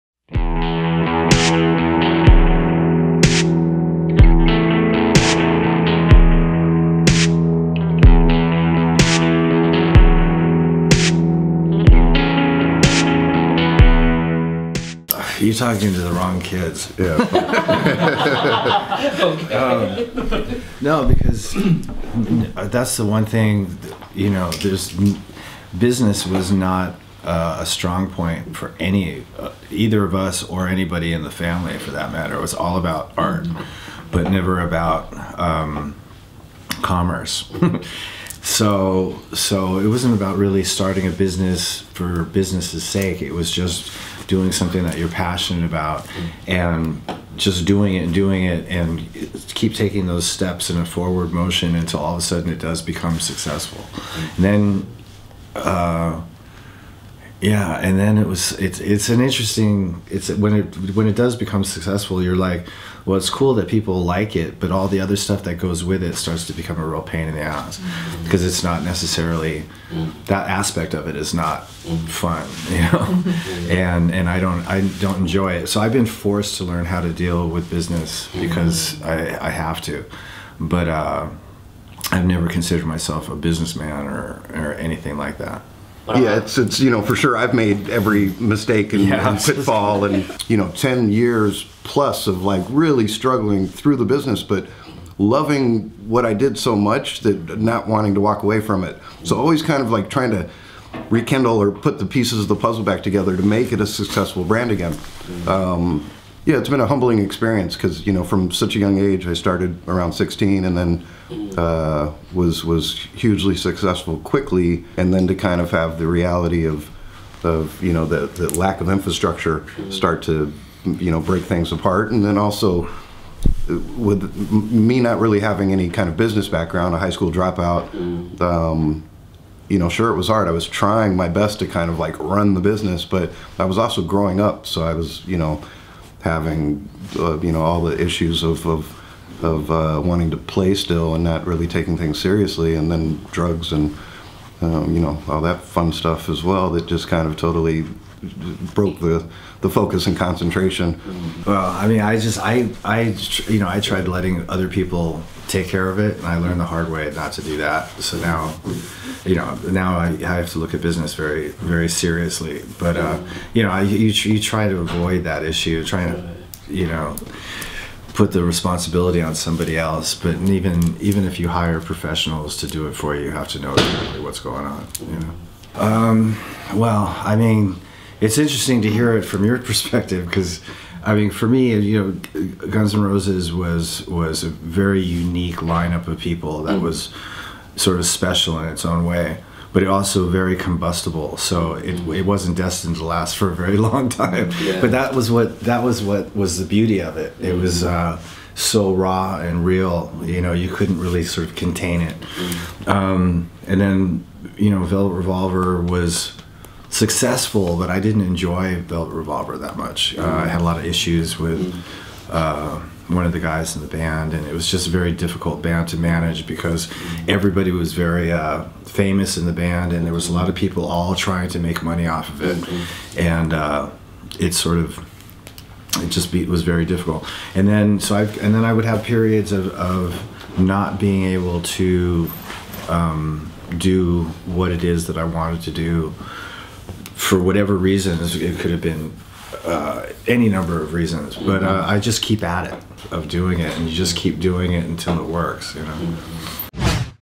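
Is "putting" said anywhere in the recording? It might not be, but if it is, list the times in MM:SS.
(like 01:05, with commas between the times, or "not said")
not said.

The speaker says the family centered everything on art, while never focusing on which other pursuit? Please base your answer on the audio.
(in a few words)
commerce.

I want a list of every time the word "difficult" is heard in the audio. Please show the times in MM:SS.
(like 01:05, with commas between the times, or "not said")
03:35, 03:46.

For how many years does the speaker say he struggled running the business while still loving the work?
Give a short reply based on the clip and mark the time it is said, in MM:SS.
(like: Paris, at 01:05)
10, at 01:30.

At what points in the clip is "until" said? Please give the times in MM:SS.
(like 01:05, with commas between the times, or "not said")
00:51, 04:04.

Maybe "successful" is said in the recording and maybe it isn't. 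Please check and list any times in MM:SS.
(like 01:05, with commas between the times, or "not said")
00:53, 01:01, 01:43, 01:53, 03:26.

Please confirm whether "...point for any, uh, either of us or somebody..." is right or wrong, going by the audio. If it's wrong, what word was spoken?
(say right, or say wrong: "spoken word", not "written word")
wrong: "anybody", not "somebody".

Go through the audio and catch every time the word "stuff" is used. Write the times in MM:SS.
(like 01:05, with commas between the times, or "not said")
01:05, 02:25.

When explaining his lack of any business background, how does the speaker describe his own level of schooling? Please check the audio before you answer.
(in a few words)
high school dropout.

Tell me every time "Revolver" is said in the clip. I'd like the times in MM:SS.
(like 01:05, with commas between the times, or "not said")
03:25, 03:29.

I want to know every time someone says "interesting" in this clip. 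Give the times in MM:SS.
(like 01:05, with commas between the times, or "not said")
00:59, 02:58.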